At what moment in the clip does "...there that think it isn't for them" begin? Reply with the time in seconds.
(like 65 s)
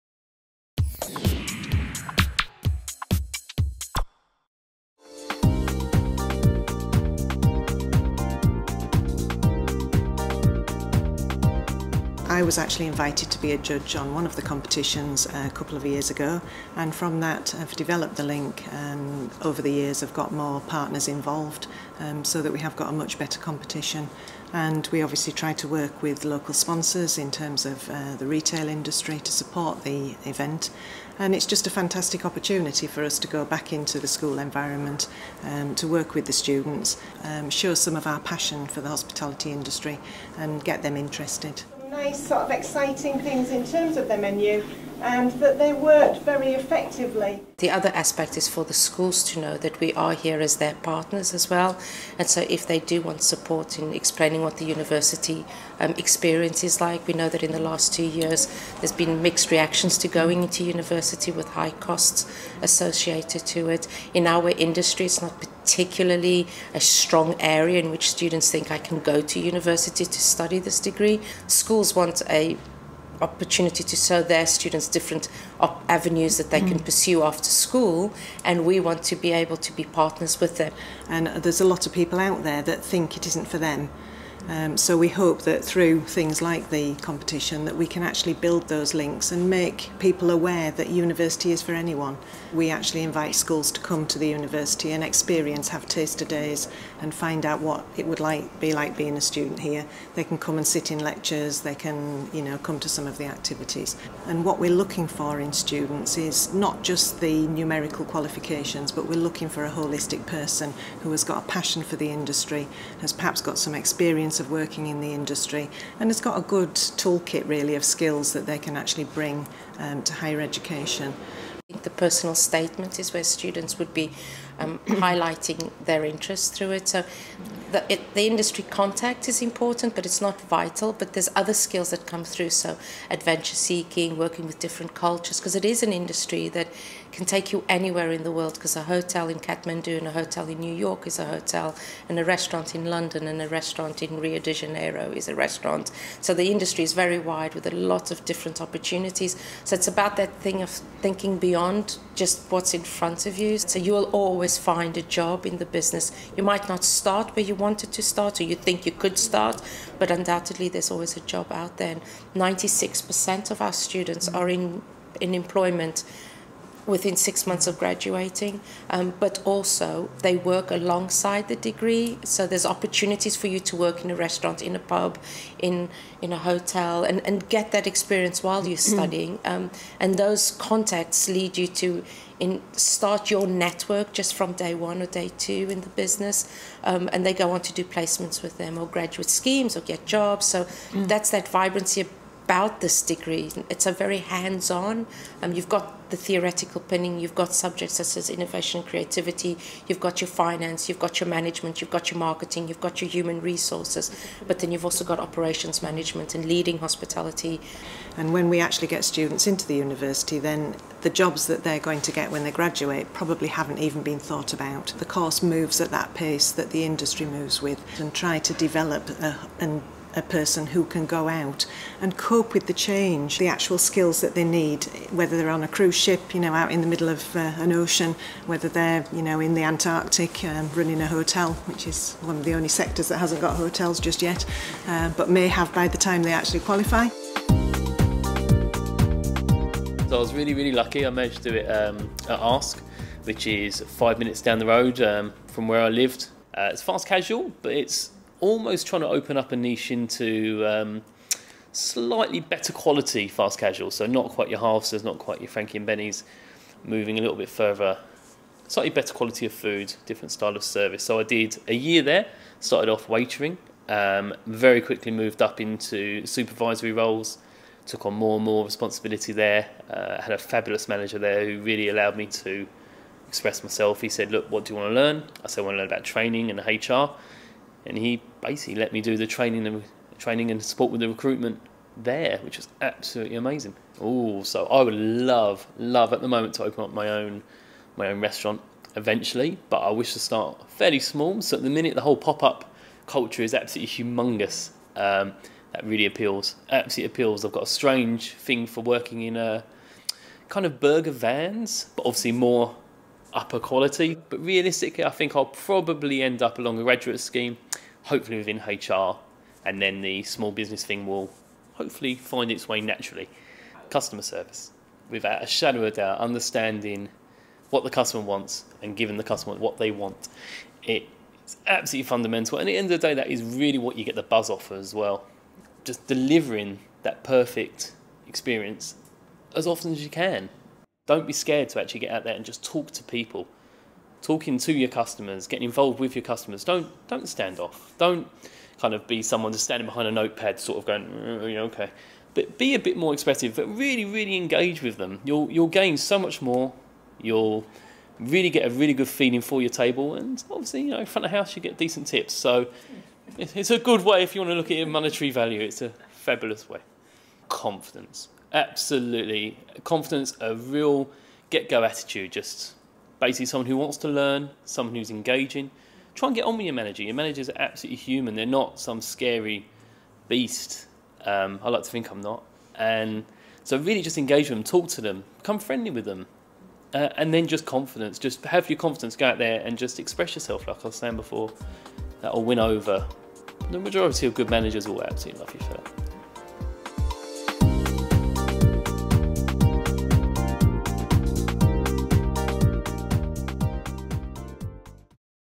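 82 s.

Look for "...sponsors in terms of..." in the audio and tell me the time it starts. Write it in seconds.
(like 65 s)
26 s.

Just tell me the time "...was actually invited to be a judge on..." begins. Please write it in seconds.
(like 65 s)
12 s.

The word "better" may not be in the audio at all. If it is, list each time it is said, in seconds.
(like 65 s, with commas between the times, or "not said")
23 s, 252 s, 258 s.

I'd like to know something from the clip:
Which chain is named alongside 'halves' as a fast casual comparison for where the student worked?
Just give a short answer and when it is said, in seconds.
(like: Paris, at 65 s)
Frankie and Benny's, at 255 s.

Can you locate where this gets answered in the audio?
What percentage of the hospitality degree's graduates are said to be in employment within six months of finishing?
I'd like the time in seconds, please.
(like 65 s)
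162 s.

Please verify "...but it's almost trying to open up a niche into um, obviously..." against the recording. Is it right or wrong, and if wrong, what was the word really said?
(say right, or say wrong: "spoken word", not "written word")
wrong: "slightly", not "obviously".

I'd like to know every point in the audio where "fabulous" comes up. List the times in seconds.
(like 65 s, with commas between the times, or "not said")
270 s, 356 s.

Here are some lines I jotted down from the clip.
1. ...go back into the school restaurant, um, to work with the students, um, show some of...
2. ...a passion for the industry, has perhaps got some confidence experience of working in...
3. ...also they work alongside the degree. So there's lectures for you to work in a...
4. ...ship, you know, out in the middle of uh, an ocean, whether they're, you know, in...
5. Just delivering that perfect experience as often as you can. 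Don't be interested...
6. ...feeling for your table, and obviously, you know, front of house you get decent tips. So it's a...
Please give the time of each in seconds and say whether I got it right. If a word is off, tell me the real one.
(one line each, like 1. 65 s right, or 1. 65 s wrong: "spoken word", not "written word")
1. 33 s wrong: "environment", not "restaurant"
2. 111 s wrong: "experience", not "confidence"
3. 169 s wrong: "opportunities", not "lectures"
4. 225 s right
5. 325 s wrong: "scared", not "interested"
6. 349 s right.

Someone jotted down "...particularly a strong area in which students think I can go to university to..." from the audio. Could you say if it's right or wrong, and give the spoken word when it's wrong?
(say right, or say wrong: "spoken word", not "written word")
right.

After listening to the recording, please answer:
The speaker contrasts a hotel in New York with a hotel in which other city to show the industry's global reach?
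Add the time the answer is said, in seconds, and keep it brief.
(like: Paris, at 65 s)
Kathmandu, at 139 s.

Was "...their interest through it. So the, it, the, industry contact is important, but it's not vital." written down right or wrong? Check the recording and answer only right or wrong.
right.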